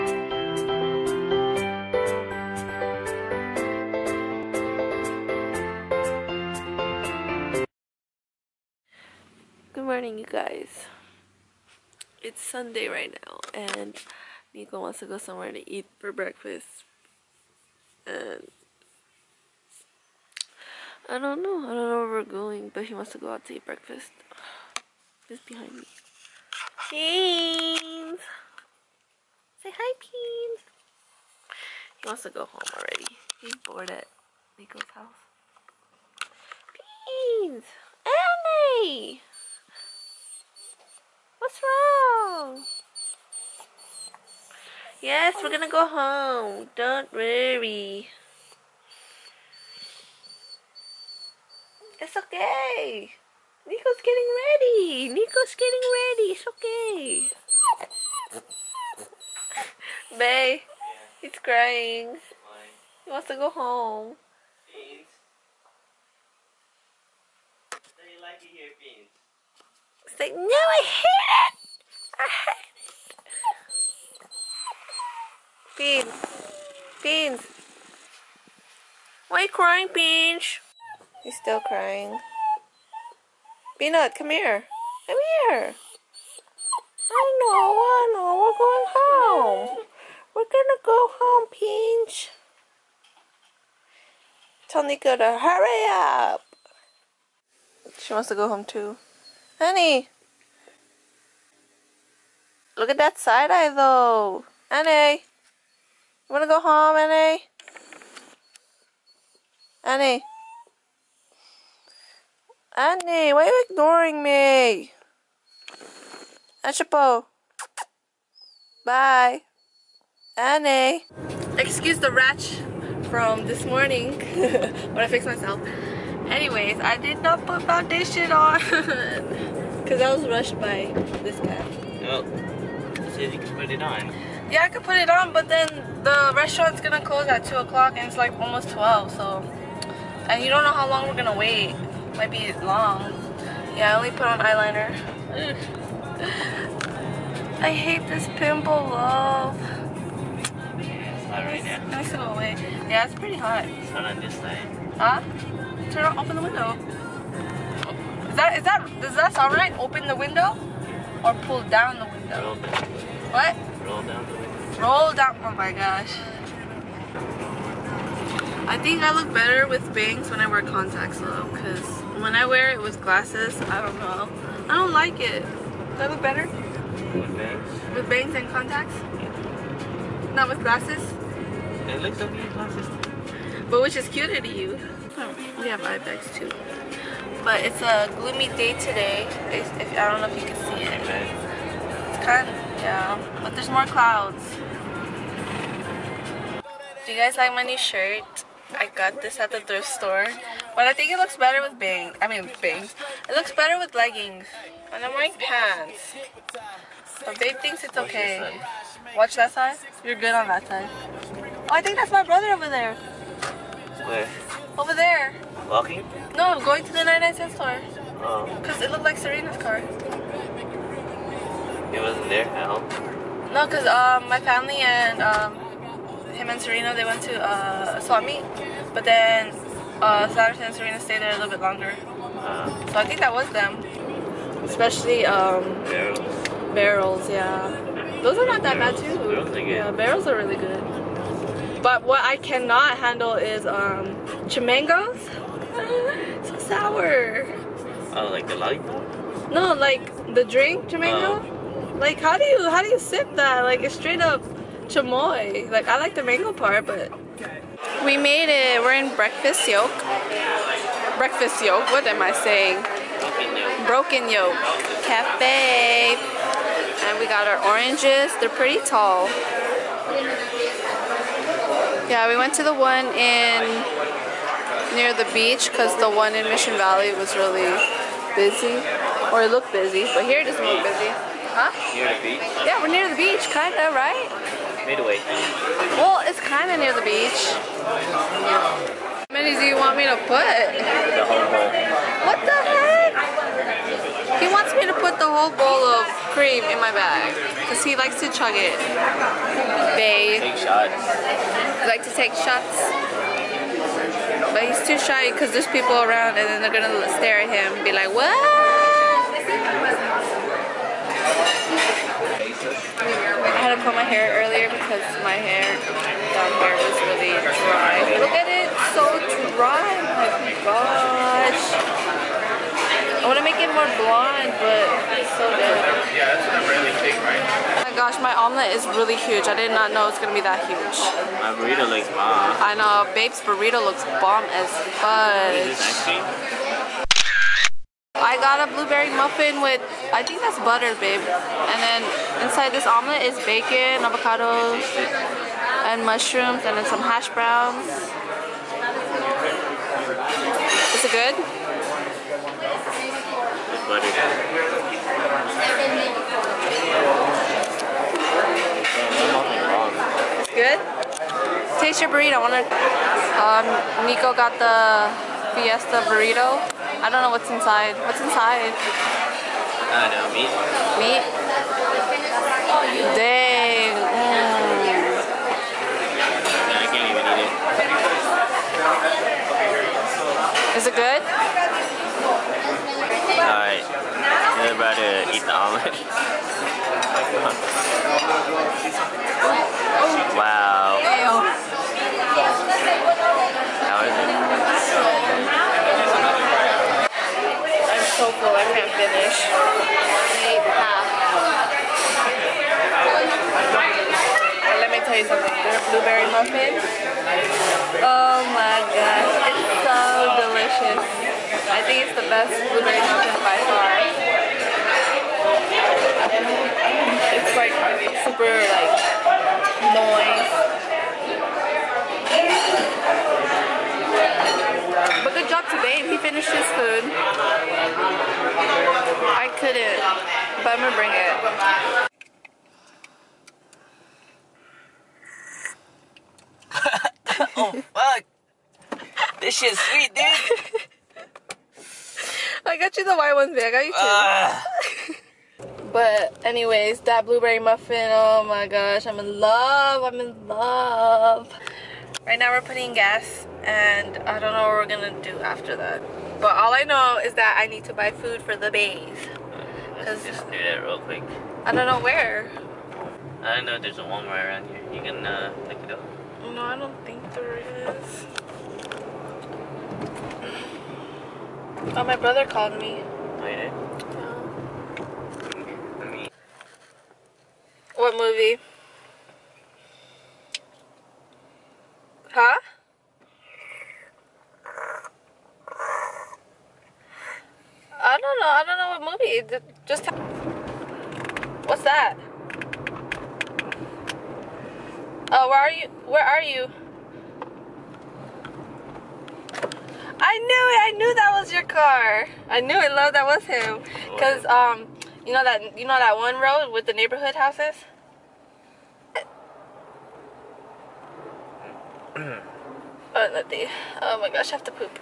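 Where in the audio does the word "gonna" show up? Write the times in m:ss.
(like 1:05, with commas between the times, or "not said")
0:45, 1:30, 2:16, 2:21, 5:30, 7:10, 7:34.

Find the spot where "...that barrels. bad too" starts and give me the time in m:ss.
3:58.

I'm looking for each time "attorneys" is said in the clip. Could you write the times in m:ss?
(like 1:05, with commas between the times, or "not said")
not said.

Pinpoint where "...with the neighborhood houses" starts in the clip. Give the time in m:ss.
8:26.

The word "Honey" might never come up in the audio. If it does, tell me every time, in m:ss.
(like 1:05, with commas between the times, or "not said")
1:39.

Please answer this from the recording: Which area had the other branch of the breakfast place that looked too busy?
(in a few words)
Mission Valley.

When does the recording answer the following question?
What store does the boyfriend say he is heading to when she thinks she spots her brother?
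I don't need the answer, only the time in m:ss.
3:37.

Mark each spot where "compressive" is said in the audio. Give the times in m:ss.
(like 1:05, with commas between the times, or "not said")
not said.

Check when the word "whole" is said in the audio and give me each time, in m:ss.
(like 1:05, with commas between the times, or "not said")
4:51, 4:55.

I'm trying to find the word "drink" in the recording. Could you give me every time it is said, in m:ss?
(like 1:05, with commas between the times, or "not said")
4:10.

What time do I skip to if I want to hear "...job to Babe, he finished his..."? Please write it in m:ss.
7:05.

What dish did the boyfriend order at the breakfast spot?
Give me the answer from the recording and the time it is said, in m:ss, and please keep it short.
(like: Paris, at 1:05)
Fiesta burrito, at 6:05.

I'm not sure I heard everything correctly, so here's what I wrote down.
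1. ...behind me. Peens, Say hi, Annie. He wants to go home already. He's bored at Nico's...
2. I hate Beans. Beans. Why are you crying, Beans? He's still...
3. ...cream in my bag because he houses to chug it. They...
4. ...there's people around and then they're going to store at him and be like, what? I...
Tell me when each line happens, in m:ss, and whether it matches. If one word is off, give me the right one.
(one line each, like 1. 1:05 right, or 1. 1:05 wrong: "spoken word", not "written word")
1. 0:25 wrong: "Peens", not "Annie"
2. 1:15 right
3. 4:56 wrong: "likes", not "houses"
4. 5:05 wrong: "stare", not "store".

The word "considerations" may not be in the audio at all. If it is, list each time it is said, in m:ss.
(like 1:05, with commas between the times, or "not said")
not said.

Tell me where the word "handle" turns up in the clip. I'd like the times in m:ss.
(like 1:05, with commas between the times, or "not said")
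4:02.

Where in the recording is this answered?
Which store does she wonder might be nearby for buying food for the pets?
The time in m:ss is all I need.
7:44.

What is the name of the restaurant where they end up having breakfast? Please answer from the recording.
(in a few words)
Broken Yolk Cafe.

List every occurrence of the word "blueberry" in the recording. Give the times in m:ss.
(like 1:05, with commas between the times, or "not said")
5:38, 6:45, 6:52, 7:27.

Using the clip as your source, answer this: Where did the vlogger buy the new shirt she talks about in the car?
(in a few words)
thrift store.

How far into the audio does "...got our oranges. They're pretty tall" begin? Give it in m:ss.
4:27.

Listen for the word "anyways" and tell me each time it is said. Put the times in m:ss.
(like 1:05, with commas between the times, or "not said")
2:06, 7:26.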